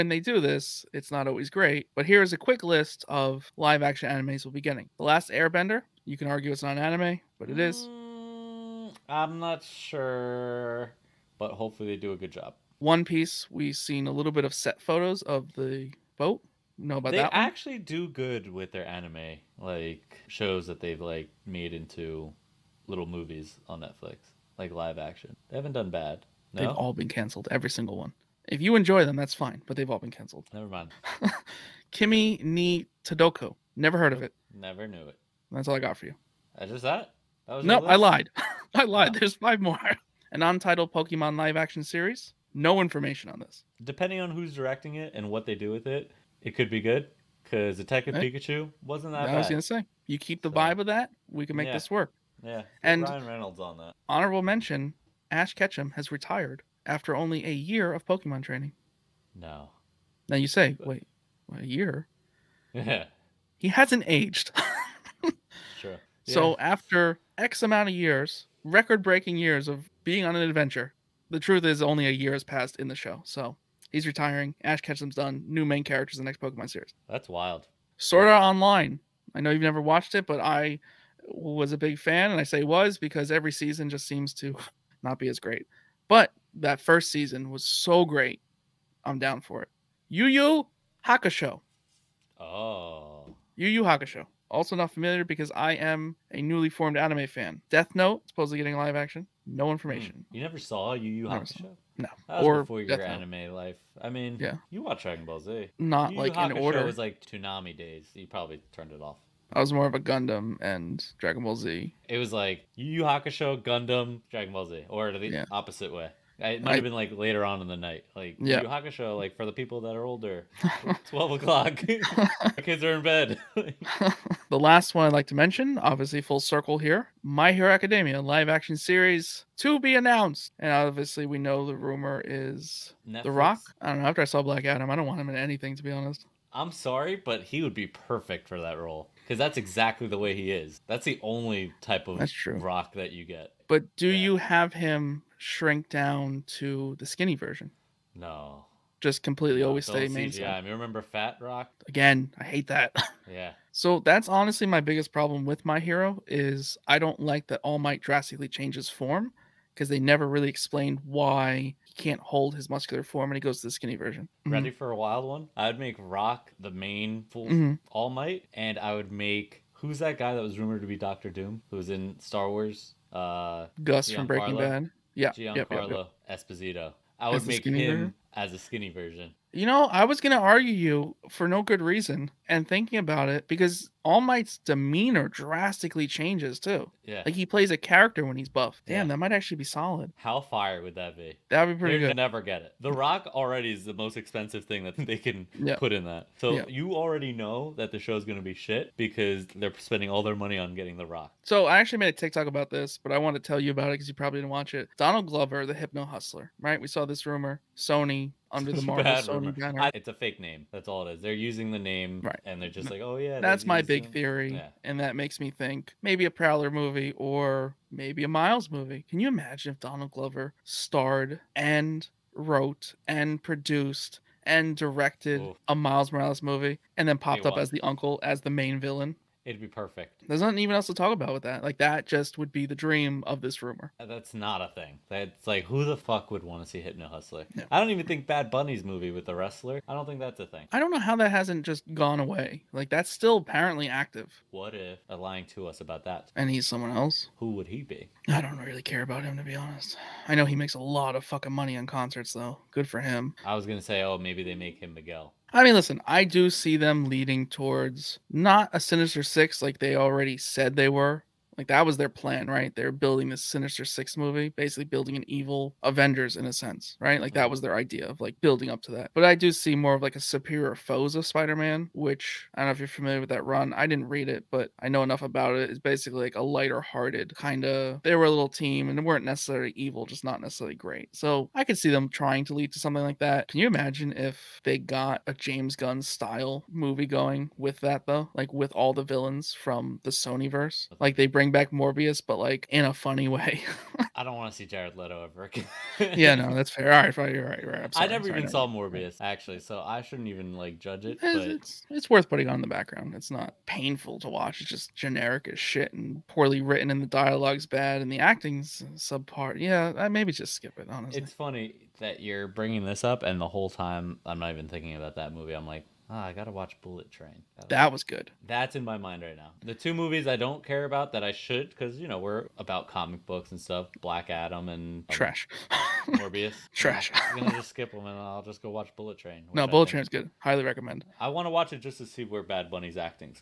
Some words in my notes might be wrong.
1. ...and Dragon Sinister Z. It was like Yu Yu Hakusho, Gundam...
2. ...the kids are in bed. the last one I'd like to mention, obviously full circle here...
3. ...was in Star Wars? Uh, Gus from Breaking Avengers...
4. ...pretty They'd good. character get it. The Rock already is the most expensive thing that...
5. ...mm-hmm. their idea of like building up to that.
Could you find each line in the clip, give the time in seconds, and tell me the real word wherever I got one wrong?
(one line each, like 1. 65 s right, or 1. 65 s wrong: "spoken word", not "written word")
1. 110 s wrong: "Ball", not "Sinister"
2. 121 s right
3. 171 s wrong: "Bad", not "Avengers"
4. 191 s wrong: "never", not "character"
5. 267 s right.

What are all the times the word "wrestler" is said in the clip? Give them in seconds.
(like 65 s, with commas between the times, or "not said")
239 s.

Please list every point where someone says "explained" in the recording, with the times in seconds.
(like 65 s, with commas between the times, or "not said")
160 s.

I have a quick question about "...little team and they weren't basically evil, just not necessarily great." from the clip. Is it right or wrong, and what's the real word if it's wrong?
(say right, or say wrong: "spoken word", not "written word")
wrong: "necessarily", not "basically".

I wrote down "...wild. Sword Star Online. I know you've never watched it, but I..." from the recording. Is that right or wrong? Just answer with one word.
wrong.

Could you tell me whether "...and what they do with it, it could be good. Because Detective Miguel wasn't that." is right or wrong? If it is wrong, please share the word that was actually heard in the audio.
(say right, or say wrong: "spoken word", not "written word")
wrong: "Pikachu", not "Miguel".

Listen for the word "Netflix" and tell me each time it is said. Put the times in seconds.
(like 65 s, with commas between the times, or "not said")
23 s, 133 s.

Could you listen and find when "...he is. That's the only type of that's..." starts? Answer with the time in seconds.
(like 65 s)
140 s.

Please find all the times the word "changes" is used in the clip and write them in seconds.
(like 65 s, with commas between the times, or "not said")
158 s, 186 s.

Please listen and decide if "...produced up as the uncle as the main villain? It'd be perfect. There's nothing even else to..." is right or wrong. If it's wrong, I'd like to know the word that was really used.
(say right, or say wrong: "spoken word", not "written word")
wrong: "popped", not "produced".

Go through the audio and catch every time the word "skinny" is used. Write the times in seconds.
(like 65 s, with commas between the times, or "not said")
147 s, 163 s, 178 s.